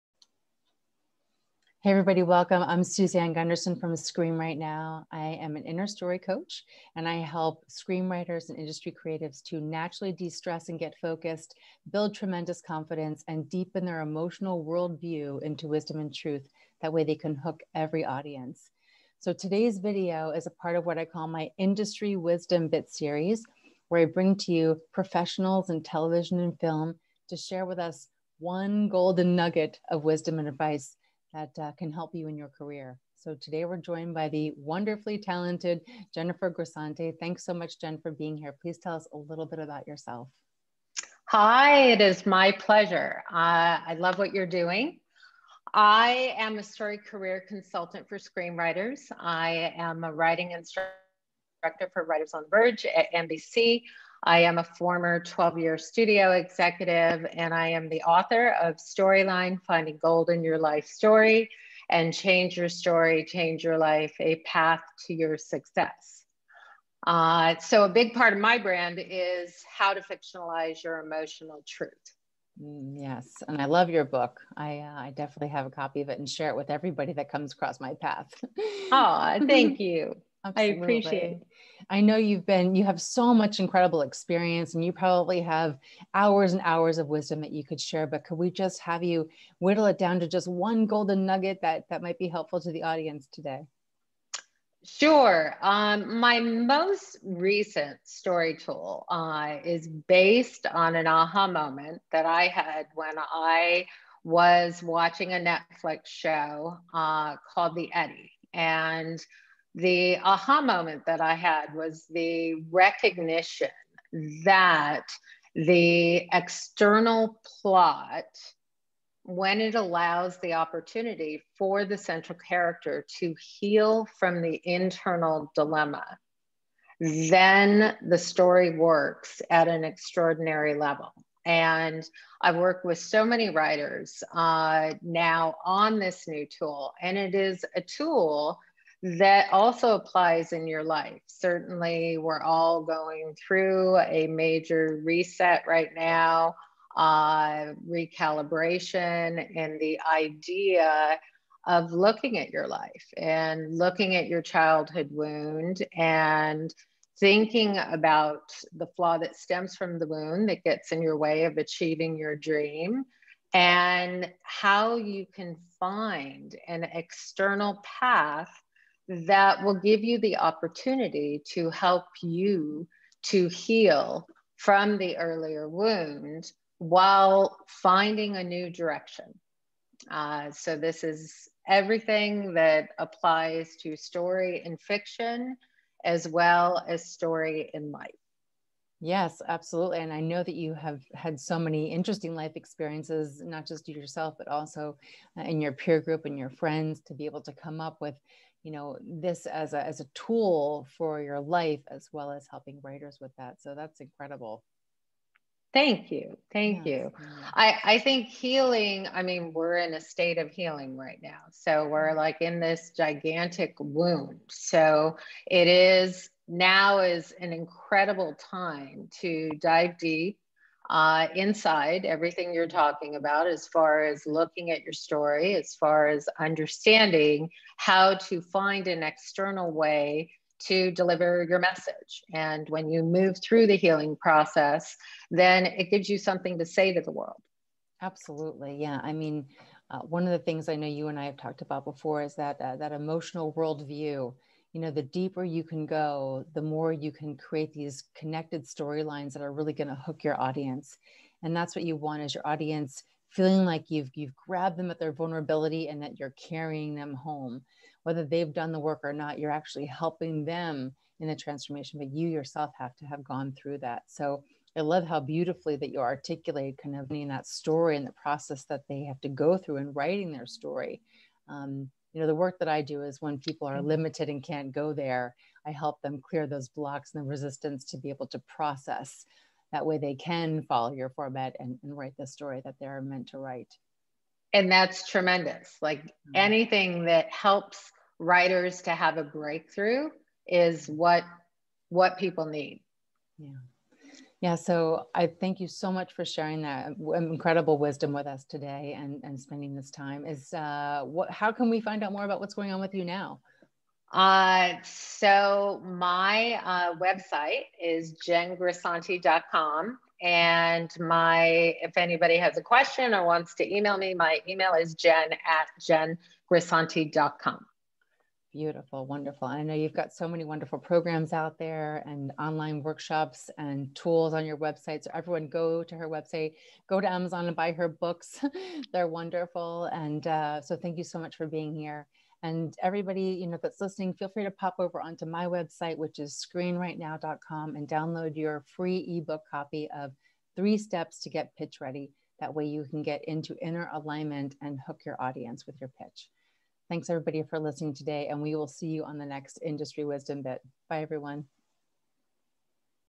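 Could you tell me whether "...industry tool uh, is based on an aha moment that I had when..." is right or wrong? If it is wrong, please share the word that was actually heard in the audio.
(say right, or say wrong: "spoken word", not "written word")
wrong: "story", not "industry".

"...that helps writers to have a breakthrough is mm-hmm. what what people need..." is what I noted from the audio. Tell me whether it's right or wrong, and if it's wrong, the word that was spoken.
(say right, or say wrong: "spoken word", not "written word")
right.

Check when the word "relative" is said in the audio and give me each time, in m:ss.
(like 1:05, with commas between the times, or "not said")
not said.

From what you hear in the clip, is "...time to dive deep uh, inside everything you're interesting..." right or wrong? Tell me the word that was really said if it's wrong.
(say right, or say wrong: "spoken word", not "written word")
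wrong: "talking", not "interesting".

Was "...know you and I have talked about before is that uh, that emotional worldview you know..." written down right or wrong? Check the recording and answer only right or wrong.
right.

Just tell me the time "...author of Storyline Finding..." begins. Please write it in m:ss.
0:58.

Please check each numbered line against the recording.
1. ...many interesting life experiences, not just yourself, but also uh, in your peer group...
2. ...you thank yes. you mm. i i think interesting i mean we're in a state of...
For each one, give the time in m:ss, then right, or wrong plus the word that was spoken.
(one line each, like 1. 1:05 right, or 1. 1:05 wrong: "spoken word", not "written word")
1. 3:11 right
2. 3:26 wrong: "healing", not "interesting".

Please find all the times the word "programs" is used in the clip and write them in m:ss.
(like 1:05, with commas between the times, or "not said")
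5:20.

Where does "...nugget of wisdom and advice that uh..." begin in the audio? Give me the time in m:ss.
0:29.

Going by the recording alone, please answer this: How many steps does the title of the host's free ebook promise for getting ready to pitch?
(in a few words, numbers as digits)
3.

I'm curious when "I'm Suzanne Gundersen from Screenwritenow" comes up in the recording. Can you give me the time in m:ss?
0:02.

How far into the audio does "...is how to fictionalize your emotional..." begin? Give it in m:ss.
1:08.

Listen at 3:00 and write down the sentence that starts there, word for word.
Uh, so, this is everything that applies to story in fiction as well as story in life.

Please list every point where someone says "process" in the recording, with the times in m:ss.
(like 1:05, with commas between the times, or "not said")
3:54, 4:28, 4:38.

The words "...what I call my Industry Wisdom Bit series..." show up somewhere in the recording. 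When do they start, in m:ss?
0:20.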